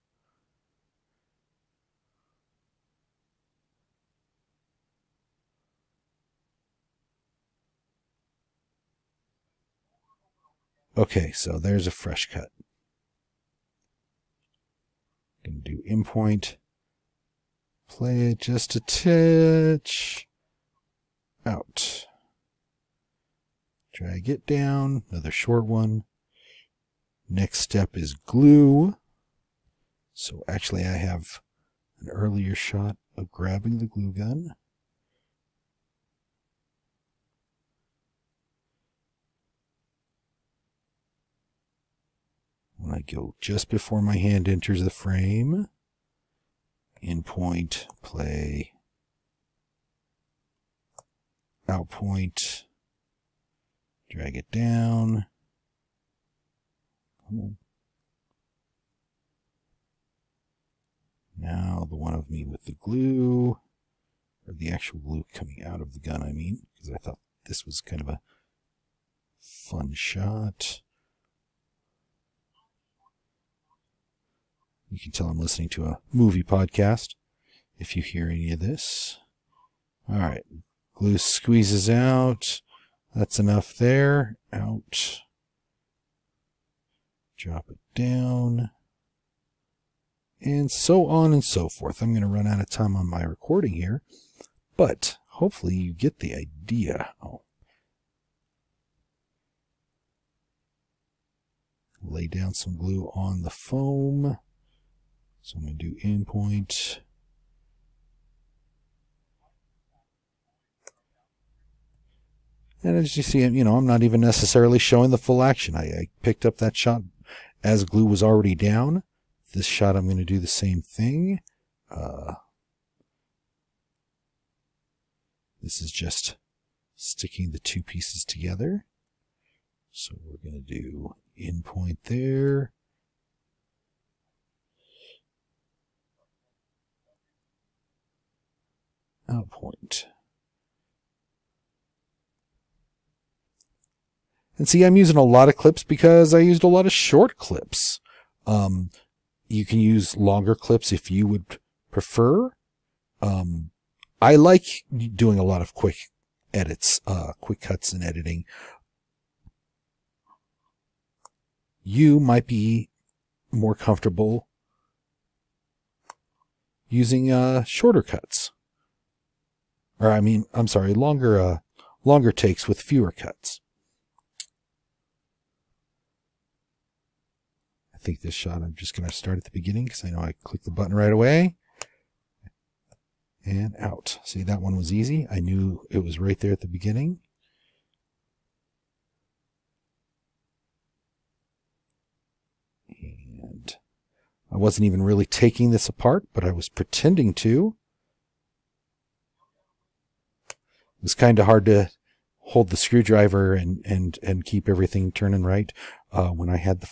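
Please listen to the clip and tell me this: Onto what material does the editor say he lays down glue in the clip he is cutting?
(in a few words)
Foam.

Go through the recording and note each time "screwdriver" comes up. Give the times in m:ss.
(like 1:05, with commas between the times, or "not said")
3:22.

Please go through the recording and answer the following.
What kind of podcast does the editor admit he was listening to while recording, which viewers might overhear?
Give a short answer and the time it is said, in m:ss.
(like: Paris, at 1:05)
Movie podcast, at 1:16.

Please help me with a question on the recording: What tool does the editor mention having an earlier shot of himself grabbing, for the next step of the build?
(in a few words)
Glue gun.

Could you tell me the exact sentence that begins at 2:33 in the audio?
Um, I like doing a lot of quick edits, uh, quick cuts and editing.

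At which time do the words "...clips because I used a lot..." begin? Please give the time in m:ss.
2:25.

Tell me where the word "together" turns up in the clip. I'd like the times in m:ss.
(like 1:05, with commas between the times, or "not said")
2:08.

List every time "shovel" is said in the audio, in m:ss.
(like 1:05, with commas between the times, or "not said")
not said.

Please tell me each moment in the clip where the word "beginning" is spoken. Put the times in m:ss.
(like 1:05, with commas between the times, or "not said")
2:59, 3:06.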